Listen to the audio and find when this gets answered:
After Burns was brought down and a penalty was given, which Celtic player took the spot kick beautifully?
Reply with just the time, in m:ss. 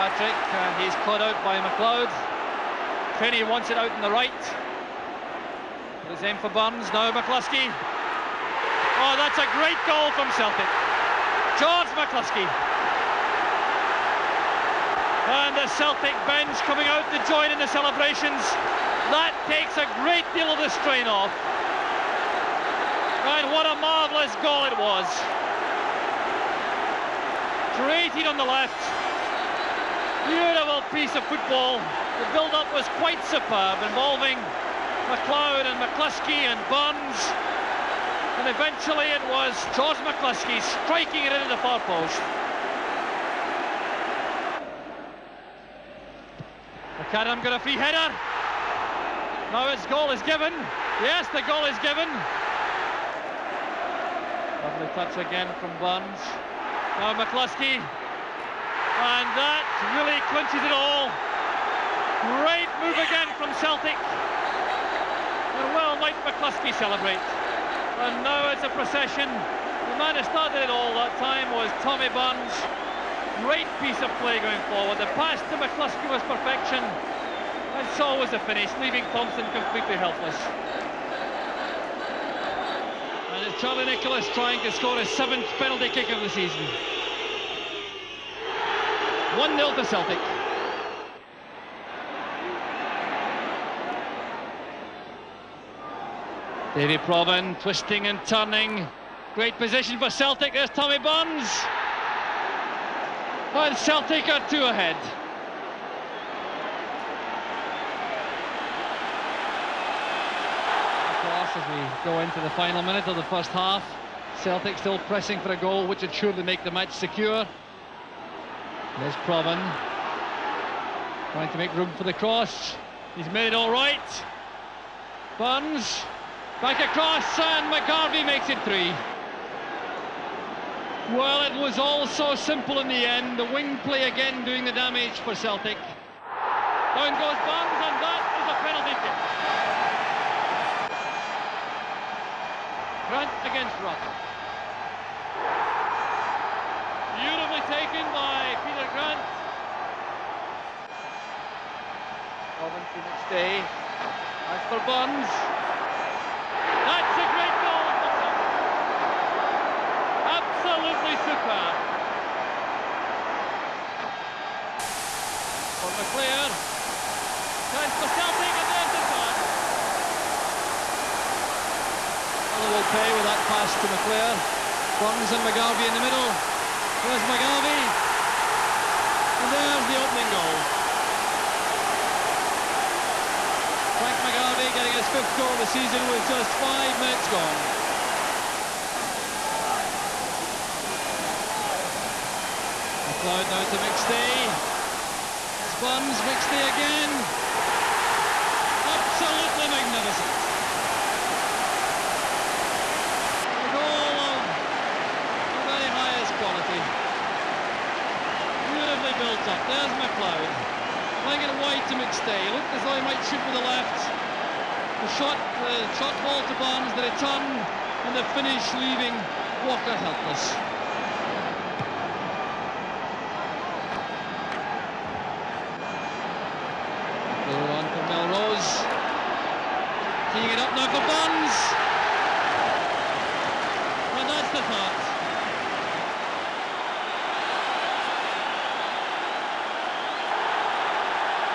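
2:28.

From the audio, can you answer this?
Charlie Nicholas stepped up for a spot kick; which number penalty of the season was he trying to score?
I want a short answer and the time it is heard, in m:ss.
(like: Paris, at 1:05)
7th, at 1:25.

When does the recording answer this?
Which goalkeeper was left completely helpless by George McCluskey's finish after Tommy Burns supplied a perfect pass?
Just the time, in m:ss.
1:19.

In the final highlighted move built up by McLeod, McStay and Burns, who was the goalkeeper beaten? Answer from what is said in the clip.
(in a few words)
Walker.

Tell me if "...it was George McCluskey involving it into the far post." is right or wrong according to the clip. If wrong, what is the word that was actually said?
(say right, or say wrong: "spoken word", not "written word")
wrong: "striking", not "involving".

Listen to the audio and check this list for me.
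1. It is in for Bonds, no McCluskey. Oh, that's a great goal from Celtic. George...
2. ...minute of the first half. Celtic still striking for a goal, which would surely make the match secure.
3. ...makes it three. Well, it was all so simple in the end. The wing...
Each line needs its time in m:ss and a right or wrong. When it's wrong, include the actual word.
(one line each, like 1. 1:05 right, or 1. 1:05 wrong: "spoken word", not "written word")
1. 0:06 right
2. 1:52 wrong: "pressing", not "striking"
3. 2:08 right.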